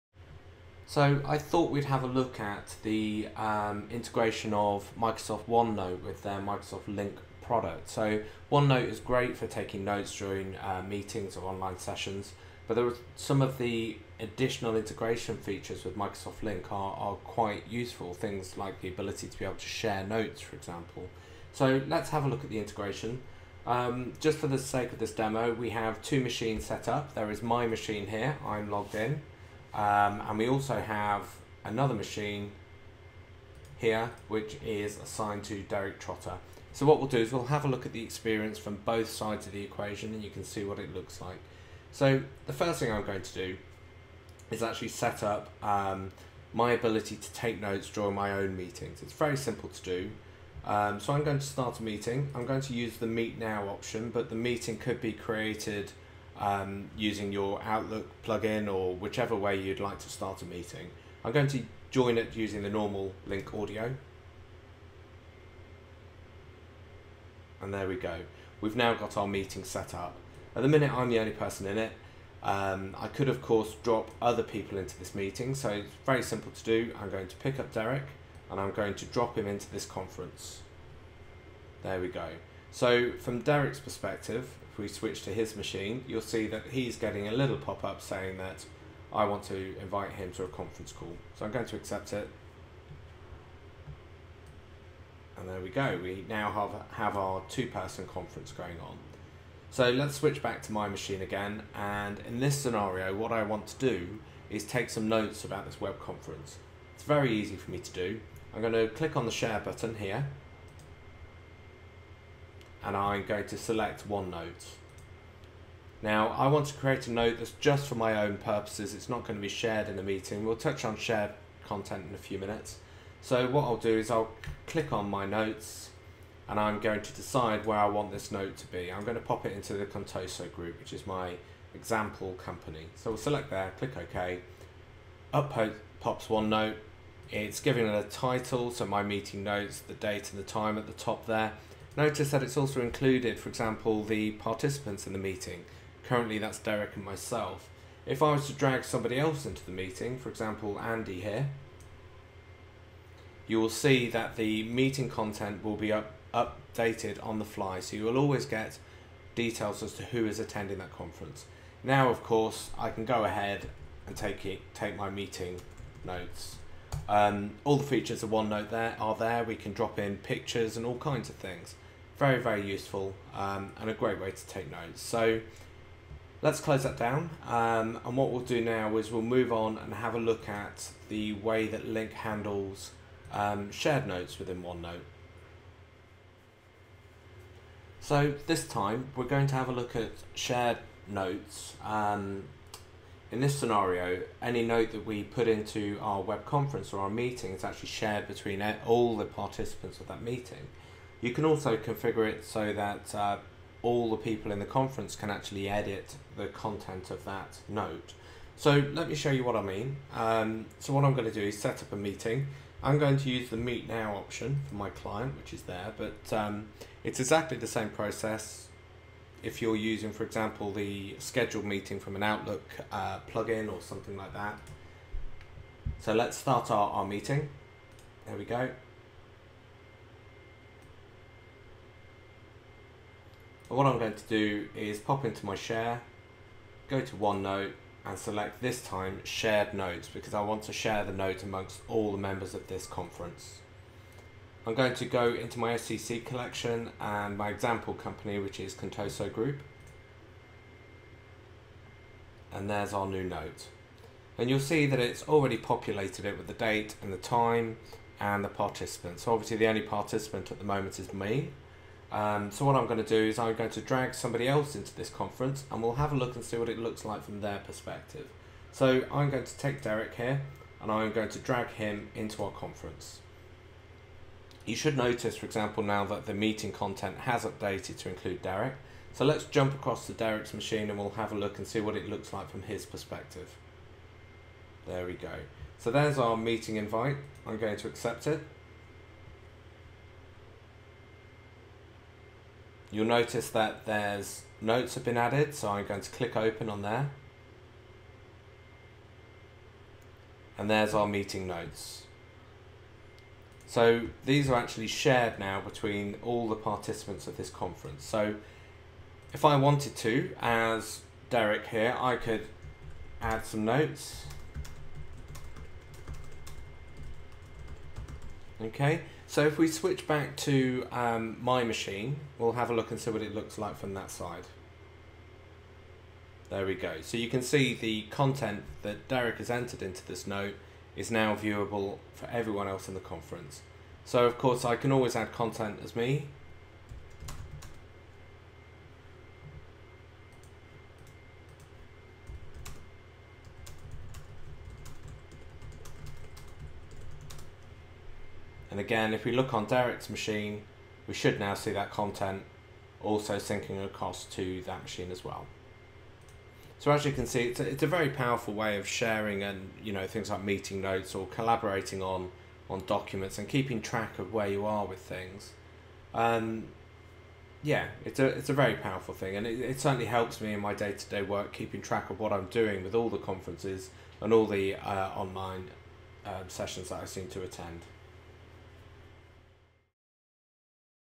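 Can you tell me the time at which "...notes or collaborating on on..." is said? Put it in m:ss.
6:00.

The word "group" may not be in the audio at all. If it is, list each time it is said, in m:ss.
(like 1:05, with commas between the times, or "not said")
2:10, 4:09.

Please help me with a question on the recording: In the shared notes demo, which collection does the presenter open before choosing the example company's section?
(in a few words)
SCC collection.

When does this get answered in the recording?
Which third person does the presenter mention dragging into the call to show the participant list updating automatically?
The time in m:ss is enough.
2:30.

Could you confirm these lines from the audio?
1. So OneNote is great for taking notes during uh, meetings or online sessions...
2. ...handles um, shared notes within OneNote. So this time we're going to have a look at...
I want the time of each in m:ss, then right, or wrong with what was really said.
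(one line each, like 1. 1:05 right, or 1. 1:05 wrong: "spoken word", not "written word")
1. 0:07 right
2. 3:02 right.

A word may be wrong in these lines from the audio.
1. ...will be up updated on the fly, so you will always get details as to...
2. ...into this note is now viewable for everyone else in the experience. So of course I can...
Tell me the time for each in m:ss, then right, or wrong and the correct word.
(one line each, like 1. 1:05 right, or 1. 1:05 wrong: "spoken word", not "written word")
1. 2:35 right
2. 5:29 wrong: "conference", not "experience".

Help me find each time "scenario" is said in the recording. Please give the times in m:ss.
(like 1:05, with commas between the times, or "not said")
1:42, 3:13.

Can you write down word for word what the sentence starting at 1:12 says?
Um, I could, of course, drop other people into this meeting, so it's very simple to do.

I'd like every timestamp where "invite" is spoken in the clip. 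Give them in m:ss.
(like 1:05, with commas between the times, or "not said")
1:29, 4:46.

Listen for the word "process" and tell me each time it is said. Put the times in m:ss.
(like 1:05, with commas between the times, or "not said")
3:37.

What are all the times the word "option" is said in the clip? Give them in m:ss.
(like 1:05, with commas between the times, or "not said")
0:53, 3:34.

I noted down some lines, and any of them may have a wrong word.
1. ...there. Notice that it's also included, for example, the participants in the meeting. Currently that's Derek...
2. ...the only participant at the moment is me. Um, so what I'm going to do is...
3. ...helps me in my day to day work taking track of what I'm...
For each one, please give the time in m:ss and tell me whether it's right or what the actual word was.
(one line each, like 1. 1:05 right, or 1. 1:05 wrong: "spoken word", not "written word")
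1. 2:21 right
2. 4:19 right
3. 6:10 wrong: "keeping", not "taking".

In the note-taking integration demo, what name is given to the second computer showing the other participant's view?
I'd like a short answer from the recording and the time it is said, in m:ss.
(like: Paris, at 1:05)
Derek Trotter, at 0:35.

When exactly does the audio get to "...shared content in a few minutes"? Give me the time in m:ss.
2:00.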